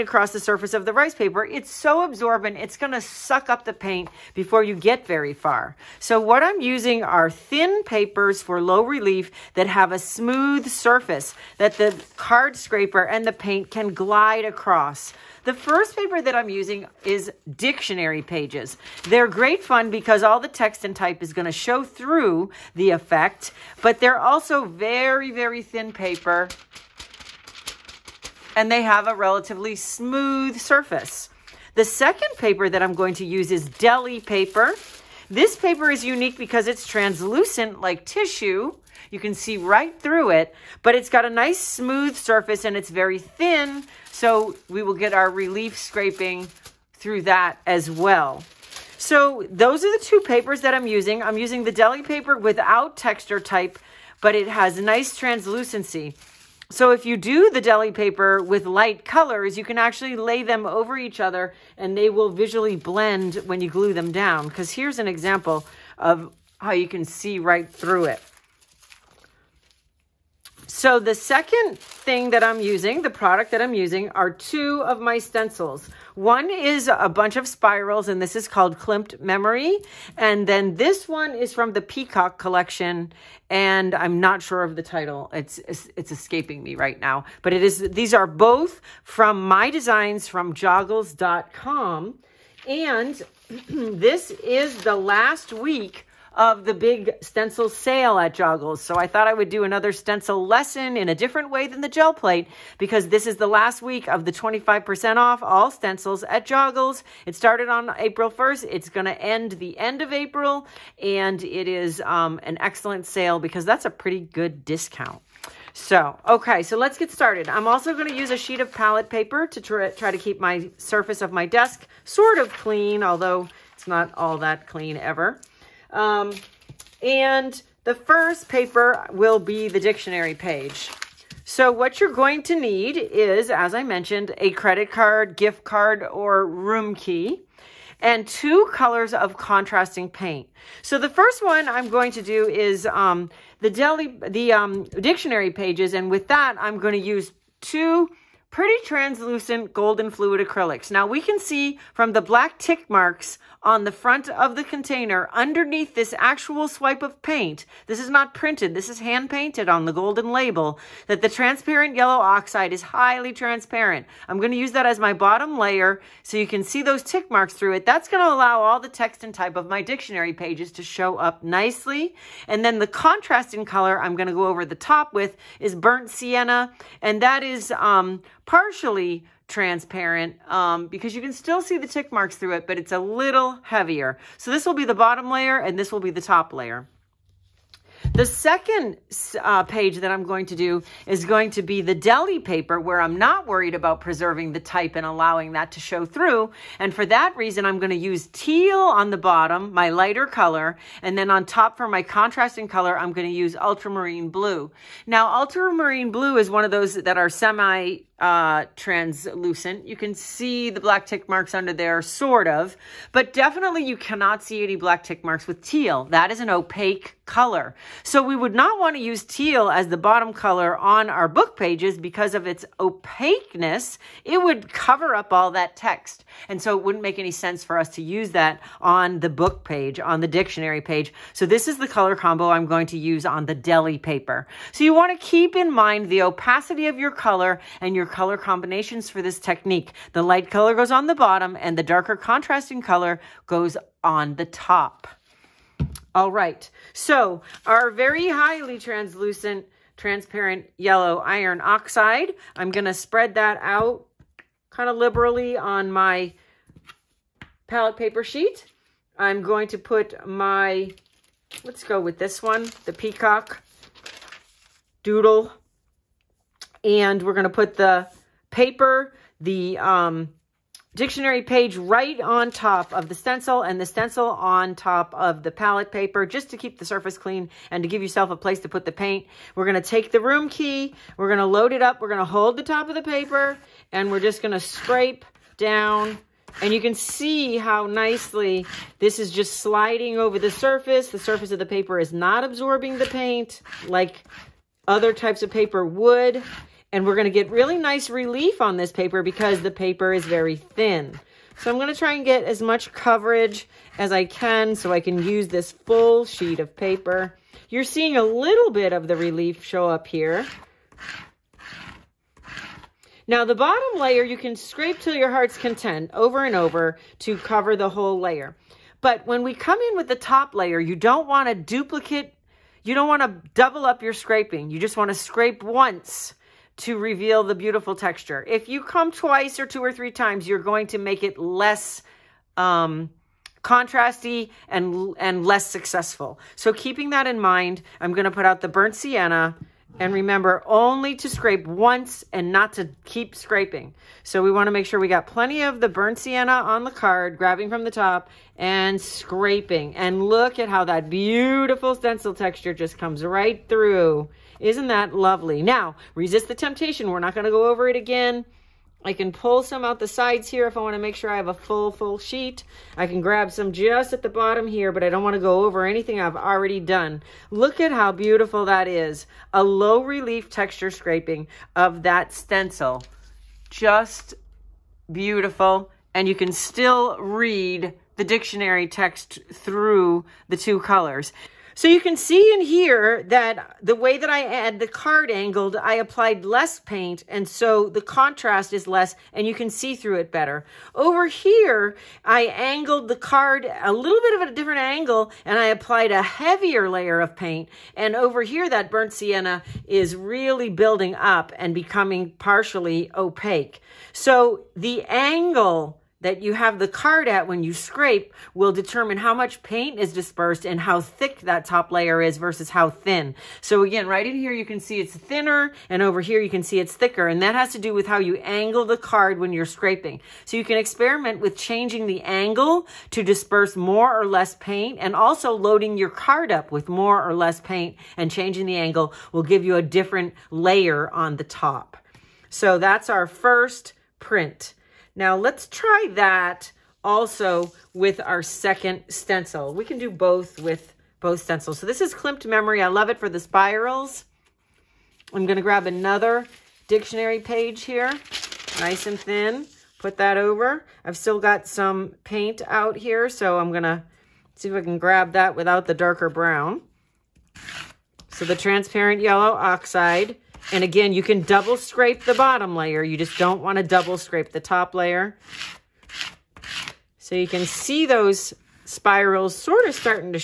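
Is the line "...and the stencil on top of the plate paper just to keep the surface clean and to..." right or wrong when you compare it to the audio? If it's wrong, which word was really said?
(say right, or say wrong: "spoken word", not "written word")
wrong: "palette", not "plate".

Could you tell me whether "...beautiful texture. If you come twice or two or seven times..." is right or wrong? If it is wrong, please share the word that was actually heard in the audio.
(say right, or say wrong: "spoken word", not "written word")
wrong: "three", not "seven".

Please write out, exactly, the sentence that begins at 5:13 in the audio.
Now the bottom layer, you can scrape till your heart's content over and over to cover the whole layer.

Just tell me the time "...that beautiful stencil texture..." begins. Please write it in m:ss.
5:50.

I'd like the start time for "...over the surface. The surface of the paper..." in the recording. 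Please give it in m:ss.
4:50.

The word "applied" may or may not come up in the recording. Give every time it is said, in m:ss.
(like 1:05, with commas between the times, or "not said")
6:25, 6:35.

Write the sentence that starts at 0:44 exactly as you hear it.
So we will get our relief scraping through that as well.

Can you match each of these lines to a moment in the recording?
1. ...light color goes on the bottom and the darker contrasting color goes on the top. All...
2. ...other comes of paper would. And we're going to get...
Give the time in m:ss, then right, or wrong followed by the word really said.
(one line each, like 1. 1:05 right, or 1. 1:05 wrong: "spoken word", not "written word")
1. 4:00 right
2. 4:54 wrong: "types", not "comes".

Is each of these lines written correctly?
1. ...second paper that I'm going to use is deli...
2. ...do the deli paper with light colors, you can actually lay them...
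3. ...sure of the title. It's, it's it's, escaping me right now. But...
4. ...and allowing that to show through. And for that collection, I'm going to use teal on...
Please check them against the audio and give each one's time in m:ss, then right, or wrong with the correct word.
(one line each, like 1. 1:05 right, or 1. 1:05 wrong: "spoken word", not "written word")
1. 0:31 right
2. 0:57 right
3. 1:24 right
4. 3:14 wrong: "reason", not "collection".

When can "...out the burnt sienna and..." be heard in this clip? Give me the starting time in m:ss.
5:38.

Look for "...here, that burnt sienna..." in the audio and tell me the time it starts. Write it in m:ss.
6:38.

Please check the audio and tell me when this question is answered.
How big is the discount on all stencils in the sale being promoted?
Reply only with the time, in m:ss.
1:44.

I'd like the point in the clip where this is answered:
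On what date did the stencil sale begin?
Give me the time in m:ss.
1:47.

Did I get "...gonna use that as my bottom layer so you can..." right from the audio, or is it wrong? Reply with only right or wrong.
right.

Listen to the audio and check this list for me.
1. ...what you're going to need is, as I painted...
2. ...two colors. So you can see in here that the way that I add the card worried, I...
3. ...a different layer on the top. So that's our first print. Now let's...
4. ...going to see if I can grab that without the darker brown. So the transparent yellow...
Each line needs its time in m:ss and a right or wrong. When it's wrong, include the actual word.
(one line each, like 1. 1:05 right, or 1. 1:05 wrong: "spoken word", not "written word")
1. 2:11 wrong: "mentioned", not "painted"
2. 6:20 wrong: "angled", not "worried"
3. 7:09 right
4. 7:33 right.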